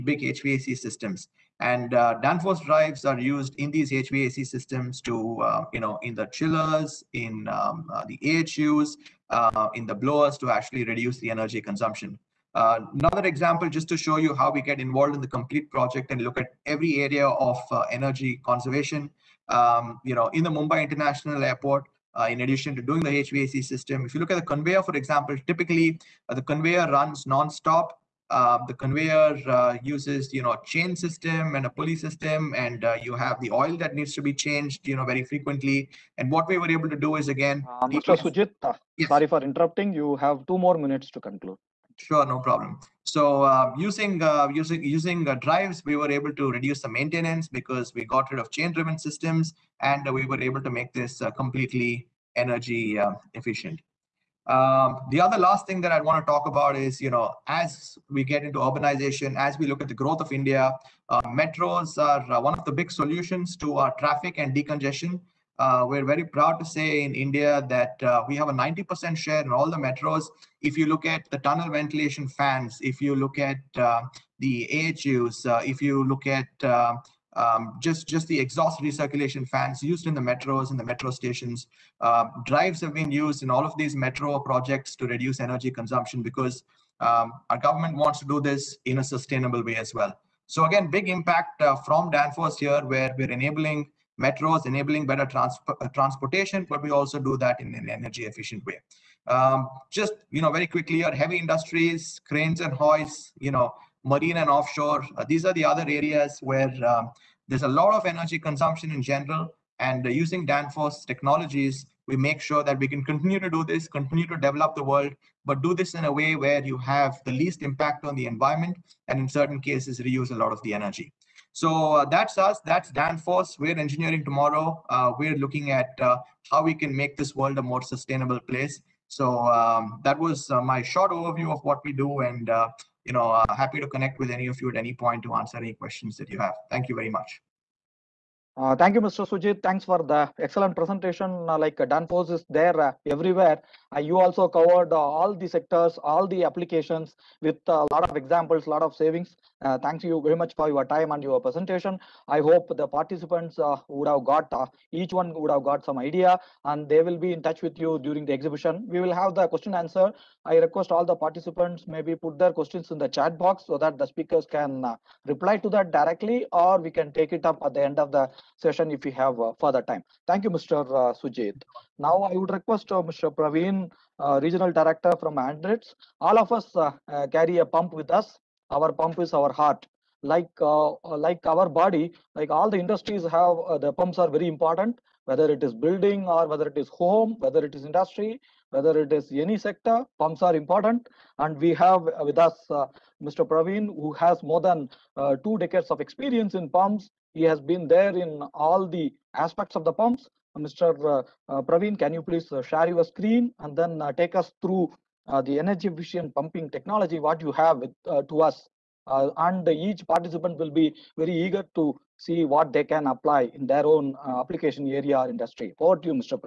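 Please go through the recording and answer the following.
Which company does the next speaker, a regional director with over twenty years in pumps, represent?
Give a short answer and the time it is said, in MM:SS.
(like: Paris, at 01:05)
Andritz, at 02:55.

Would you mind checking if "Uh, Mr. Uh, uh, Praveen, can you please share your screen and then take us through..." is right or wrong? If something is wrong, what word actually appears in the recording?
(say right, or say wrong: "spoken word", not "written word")
right.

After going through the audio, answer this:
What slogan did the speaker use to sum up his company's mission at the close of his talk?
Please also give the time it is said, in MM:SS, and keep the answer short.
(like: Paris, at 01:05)
Engineering tomorrow, at 02:03.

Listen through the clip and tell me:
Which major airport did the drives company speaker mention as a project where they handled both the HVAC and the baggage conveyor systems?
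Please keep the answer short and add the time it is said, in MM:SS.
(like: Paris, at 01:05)
Mumbai International Airport, at 00:20.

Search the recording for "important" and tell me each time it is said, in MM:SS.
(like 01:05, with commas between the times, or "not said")
03:04, 03:10.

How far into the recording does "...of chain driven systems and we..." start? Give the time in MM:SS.
00:48.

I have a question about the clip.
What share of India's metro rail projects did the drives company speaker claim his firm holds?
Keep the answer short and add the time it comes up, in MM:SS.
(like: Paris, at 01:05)
90%, at 01:08.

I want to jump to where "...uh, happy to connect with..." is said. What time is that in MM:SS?
02:13.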